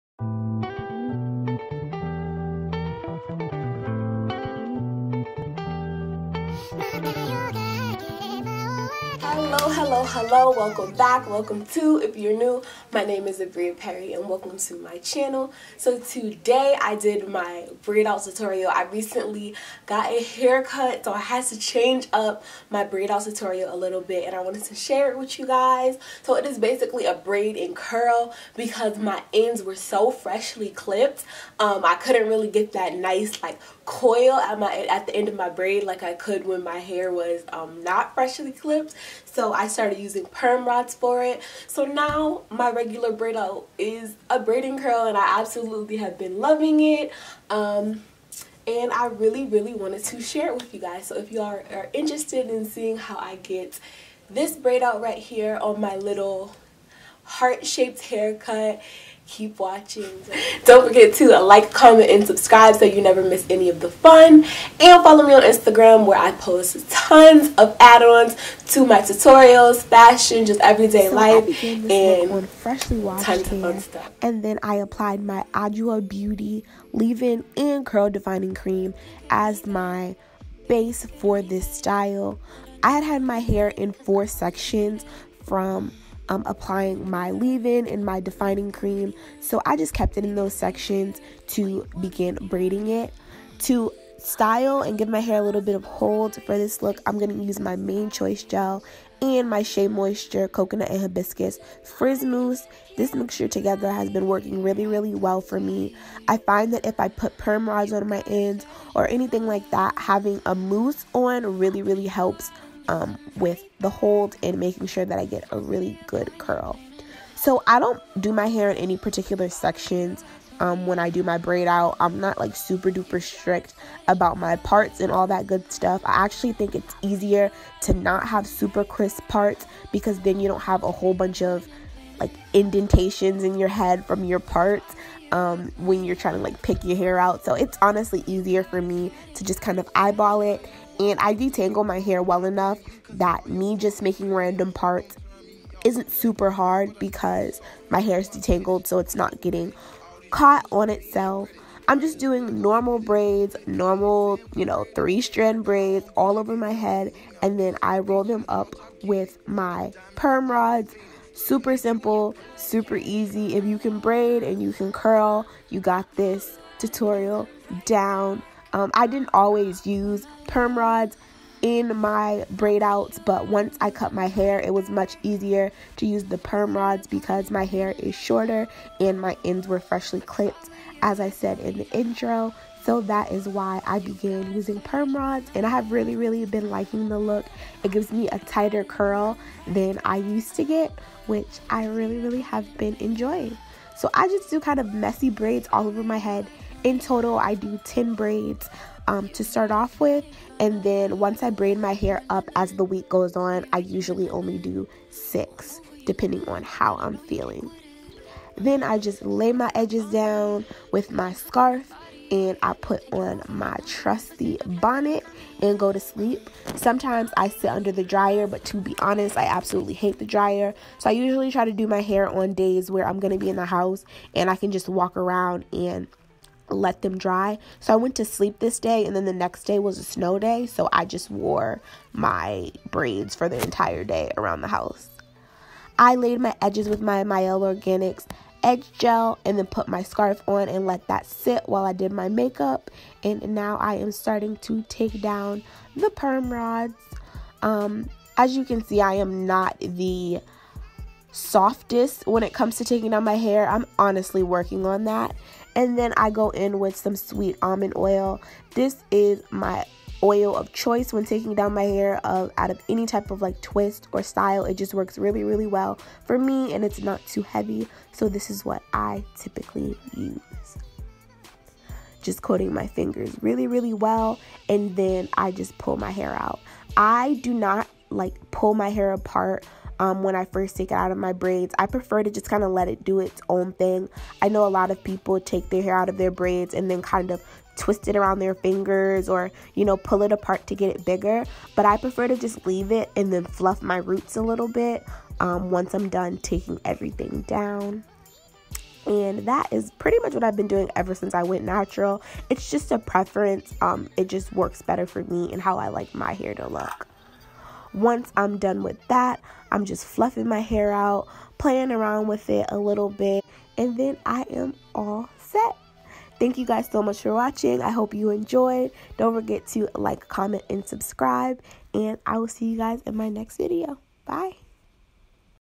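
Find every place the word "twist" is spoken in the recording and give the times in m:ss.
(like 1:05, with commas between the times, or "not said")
4:23, 4:47.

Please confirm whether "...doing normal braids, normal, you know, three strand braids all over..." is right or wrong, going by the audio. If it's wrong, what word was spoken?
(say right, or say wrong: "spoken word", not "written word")
right.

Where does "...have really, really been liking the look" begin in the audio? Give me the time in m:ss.
3:05.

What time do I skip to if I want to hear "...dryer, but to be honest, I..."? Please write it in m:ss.
3:38.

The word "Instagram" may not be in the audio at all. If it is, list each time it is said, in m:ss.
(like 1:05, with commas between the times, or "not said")
1:05.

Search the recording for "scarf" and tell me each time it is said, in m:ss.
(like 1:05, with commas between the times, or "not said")
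3:31, 4:00.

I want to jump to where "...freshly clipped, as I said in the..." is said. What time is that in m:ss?
2:59.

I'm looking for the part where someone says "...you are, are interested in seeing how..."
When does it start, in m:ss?
0:51.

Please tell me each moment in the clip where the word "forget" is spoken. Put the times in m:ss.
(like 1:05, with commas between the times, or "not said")
1:00, 5:19.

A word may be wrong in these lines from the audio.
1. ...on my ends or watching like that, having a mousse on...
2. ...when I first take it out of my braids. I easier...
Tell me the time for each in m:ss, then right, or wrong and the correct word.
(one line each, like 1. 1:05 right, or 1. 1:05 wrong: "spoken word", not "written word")
1. 1:47 wrong: "anything", not "watching"
2. 4:40 wrong: "prefer", not "easier".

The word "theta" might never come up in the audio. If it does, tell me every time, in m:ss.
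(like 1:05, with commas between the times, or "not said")
not said.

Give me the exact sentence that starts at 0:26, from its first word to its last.
So it is basically a braid and curl because my ends were so freshly clipped.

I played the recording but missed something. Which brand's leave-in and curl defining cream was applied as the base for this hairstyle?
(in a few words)
Adwoa Beauty.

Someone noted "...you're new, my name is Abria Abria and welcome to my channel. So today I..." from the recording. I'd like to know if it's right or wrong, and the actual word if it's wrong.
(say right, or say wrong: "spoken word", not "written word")
wrong: "Perry", not "Abria".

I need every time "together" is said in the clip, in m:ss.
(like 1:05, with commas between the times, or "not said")
1:43.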